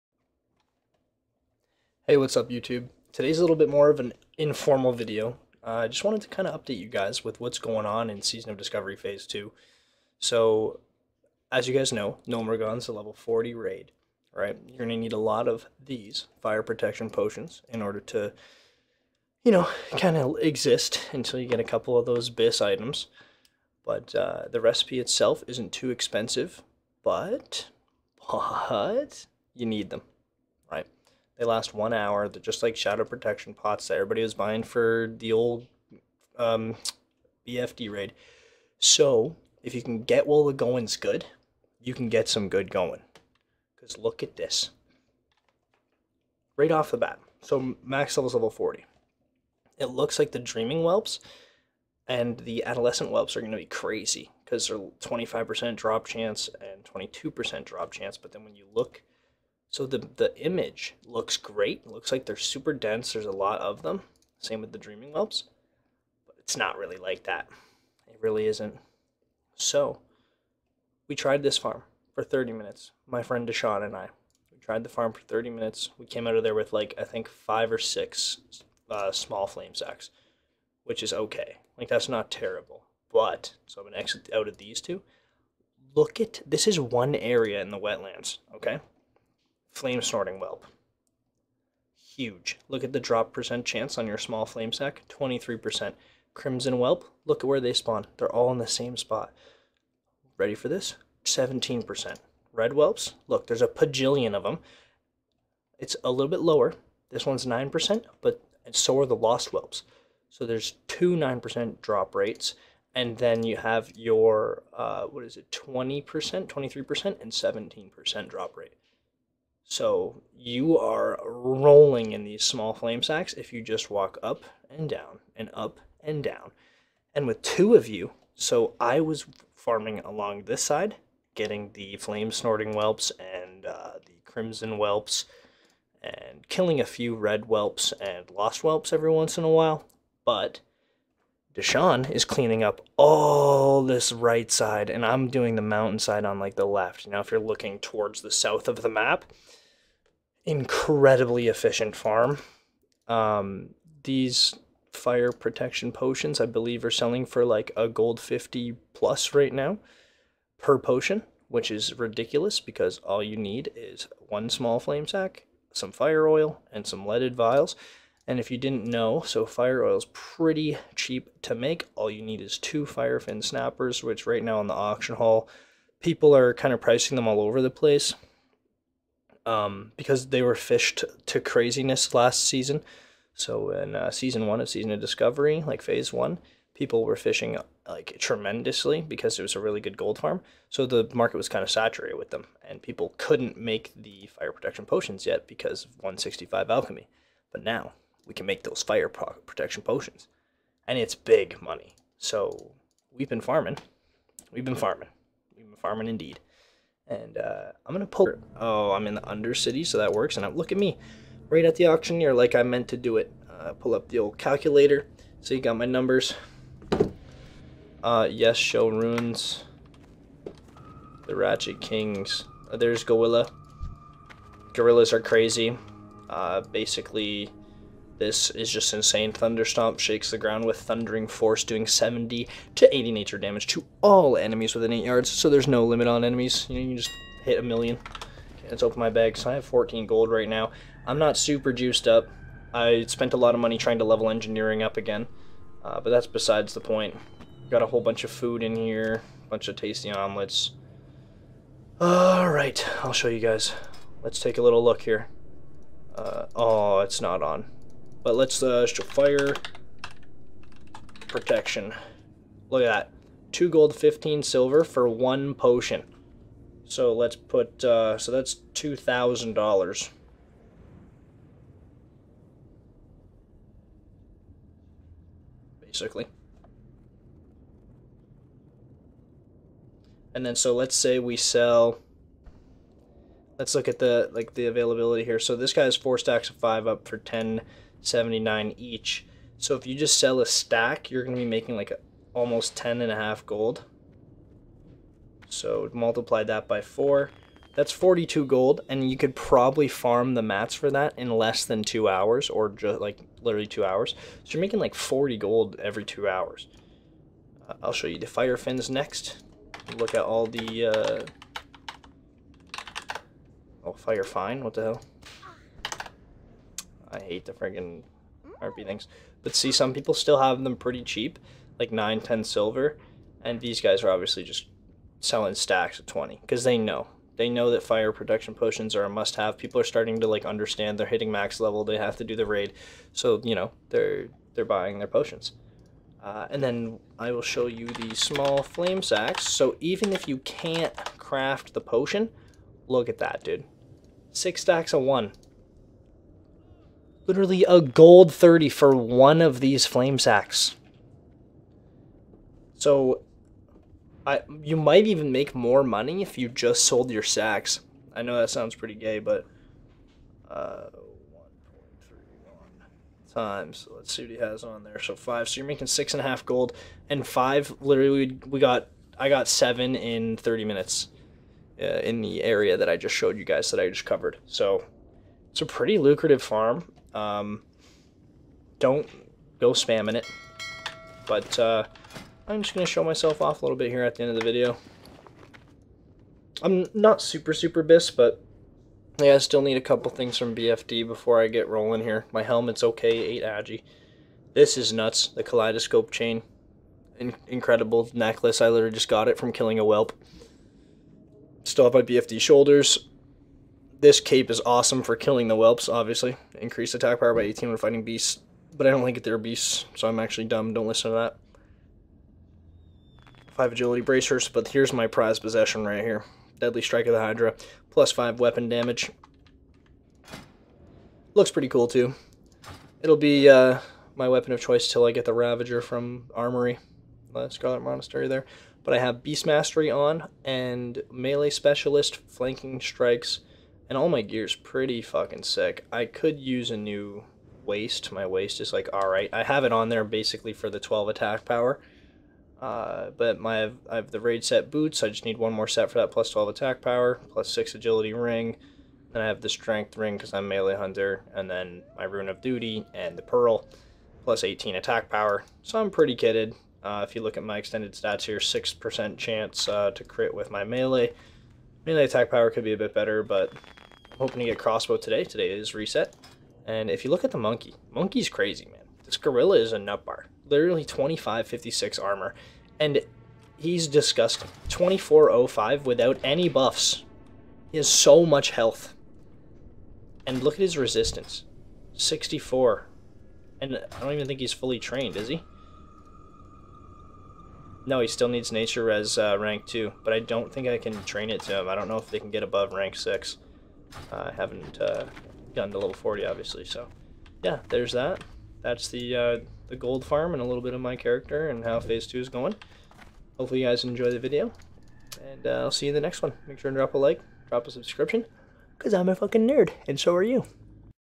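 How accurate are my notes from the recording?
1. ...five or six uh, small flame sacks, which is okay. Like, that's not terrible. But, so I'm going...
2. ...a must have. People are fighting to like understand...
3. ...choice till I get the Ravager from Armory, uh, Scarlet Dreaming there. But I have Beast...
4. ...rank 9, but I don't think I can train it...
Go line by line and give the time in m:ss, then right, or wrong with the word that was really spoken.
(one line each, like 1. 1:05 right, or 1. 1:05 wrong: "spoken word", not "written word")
1. 1:17 right
2. 5:29 wrong: "starting", not "fighting"
3. 7:04 wrong: "Monastery", not "Dreaming"
4. 8:09 wrong: "2", not "9".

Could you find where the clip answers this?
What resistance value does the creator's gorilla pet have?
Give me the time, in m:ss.
8:01.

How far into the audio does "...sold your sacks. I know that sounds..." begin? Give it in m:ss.
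5:56.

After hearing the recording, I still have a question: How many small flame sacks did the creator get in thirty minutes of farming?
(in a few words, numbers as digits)
7.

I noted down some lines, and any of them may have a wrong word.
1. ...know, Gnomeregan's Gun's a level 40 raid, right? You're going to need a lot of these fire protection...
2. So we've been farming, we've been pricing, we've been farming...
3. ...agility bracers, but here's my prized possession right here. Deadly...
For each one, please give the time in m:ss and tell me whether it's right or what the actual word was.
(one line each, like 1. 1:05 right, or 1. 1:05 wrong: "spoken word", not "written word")
1. 0:11 right
2. 3:22 wrong: "farming", not "pricing"
3. 6:53 right.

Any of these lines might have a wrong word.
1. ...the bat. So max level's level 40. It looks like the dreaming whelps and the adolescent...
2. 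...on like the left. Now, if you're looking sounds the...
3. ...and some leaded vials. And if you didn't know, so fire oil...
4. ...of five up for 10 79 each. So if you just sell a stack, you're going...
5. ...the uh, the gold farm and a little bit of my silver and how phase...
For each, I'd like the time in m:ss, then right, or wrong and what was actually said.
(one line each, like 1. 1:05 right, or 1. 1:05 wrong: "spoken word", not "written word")
1. 0:46 right
2. 2:26 wrong: "towards", not "sounds"
3. 2:46 right
4. 4:46 right
5. 8:18 wrong: "character", not "silver".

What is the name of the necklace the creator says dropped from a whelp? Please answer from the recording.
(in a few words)
Kaleidoscope chain.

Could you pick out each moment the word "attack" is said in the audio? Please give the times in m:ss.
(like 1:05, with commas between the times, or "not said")
6:46, 7:21, 7:26, 7:34, 7:42.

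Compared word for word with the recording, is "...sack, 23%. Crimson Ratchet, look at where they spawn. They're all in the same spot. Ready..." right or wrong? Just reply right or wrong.
wrong.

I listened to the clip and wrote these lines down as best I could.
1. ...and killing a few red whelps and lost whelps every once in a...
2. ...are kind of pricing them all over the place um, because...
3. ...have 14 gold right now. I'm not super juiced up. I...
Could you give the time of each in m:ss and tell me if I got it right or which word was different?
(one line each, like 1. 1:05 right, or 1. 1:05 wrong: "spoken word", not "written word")
1. 2:16 right
2. 2:56 right
3. 3:59 right.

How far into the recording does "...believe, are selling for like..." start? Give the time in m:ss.
2:36.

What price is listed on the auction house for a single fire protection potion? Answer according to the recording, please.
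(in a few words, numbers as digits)
2 gold 15 silver.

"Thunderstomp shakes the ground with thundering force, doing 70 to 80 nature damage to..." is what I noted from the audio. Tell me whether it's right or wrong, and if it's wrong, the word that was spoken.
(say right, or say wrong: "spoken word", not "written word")
right.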